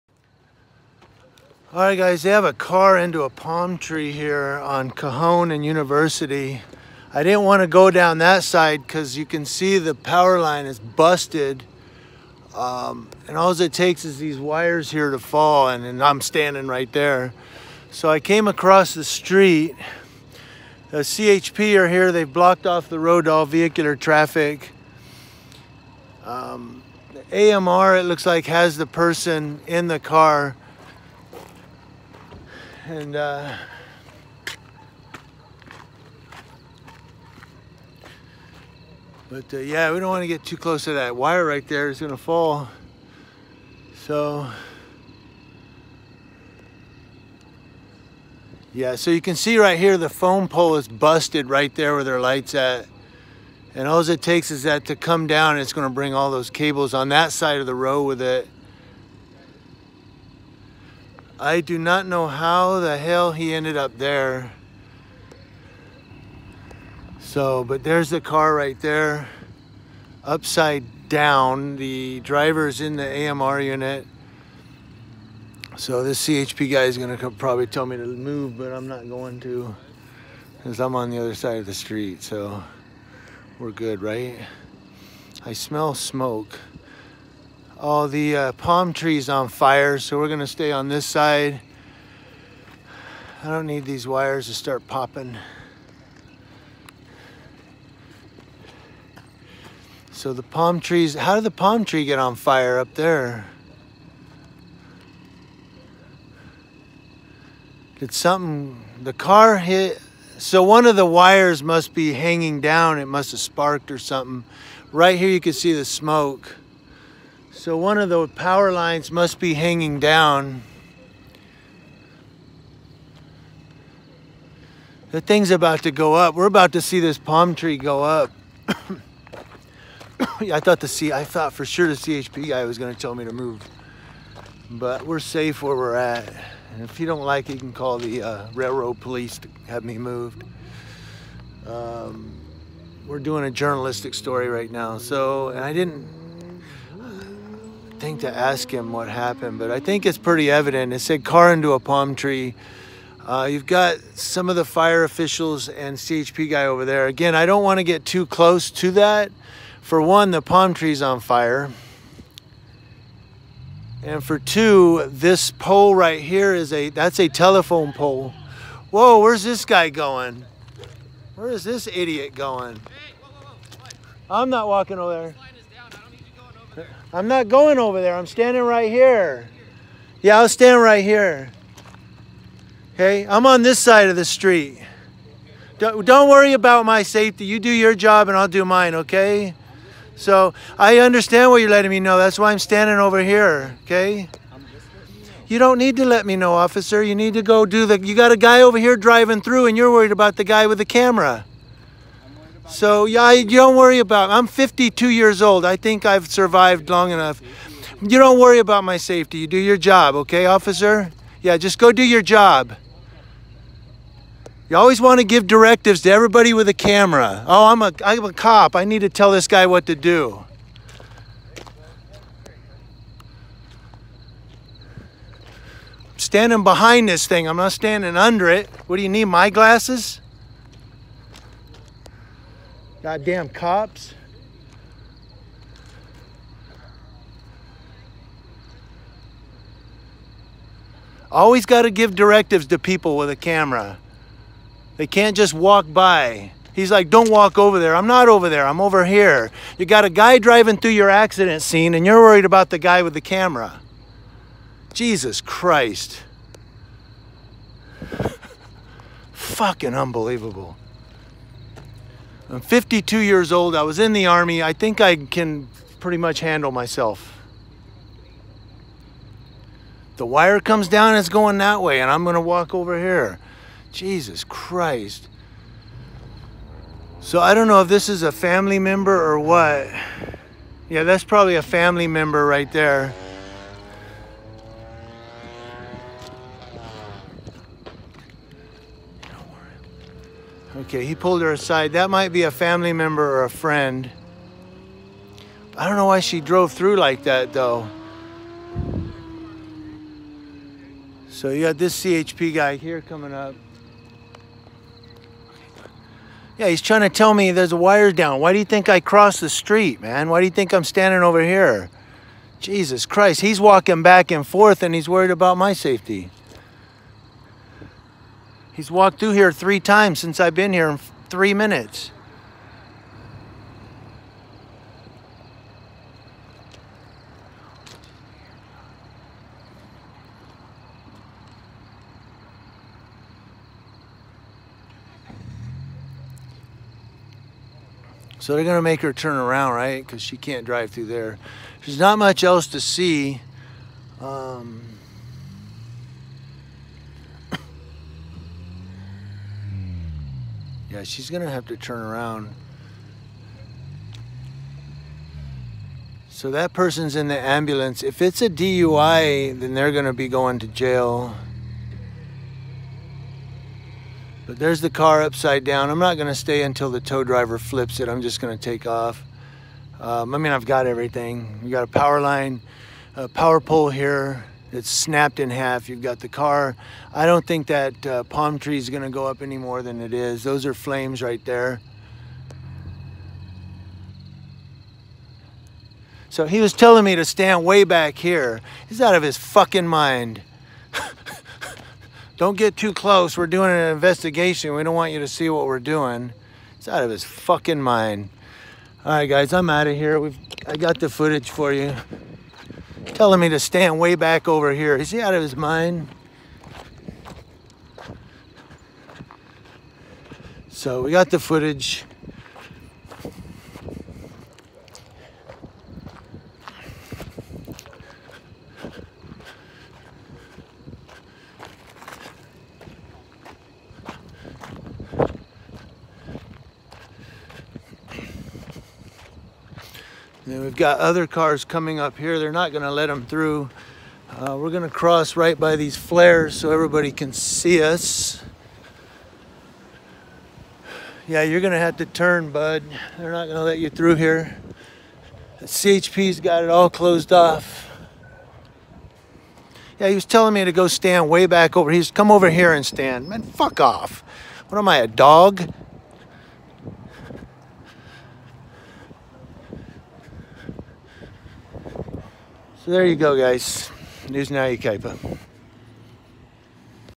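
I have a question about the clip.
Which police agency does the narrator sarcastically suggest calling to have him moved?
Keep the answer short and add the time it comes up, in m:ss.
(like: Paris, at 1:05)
Railroad police, at 2:18.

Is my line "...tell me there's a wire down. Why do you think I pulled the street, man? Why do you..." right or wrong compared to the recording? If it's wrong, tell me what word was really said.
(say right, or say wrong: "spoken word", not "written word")
wrong: "crossed", not "pulled".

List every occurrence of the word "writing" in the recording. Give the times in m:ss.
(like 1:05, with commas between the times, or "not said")
not said.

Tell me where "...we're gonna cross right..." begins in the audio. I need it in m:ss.
7:14.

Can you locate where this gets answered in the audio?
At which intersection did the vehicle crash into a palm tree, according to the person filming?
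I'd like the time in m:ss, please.
0:04.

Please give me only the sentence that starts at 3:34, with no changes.
You always want to give directives to everybody with a camera.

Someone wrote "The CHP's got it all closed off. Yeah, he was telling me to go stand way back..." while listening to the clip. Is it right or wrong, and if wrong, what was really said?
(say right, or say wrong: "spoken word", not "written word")
right.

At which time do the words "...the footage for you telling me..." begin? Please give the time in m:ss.
6:41.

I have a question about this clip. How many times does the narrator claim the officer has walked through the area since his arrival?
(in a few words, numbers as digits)
3.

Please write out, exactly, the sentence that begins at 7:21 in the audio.
Yeah, you're gonna have to turn, bud.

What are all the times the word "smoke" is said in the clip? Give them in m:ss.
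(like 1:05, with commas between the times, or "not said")
1:25, 1:55.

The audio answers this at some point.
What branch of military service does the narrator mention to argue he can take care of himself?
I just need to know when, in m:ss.
4:24.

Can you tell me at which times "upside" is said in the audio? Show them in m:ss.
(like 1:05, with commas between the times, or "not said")
1:10, 6:05.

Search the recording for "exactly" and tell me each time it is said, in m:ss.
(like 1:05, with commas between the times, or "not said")
not said.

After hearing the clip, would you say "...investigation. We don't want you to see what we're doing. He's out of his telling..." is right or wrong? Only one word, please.
wrong.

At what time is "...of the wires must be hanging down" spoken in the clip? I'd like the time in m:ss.
1:50.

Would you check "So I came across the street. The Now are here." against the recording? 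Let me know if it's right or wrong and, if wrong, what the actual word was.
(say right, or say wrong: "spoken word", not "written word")
wrong: "CHP", not "Now".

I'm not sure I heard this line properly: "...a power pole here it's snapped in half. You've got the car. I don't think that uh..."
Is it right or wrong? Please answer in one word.
right.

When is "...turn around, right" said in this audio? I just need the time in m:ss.
5:39.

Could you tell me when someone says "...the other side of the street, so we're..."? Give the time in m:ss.
1:21.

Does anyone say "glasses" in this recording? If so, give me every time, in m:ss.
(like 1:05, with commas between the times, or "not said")
3:49.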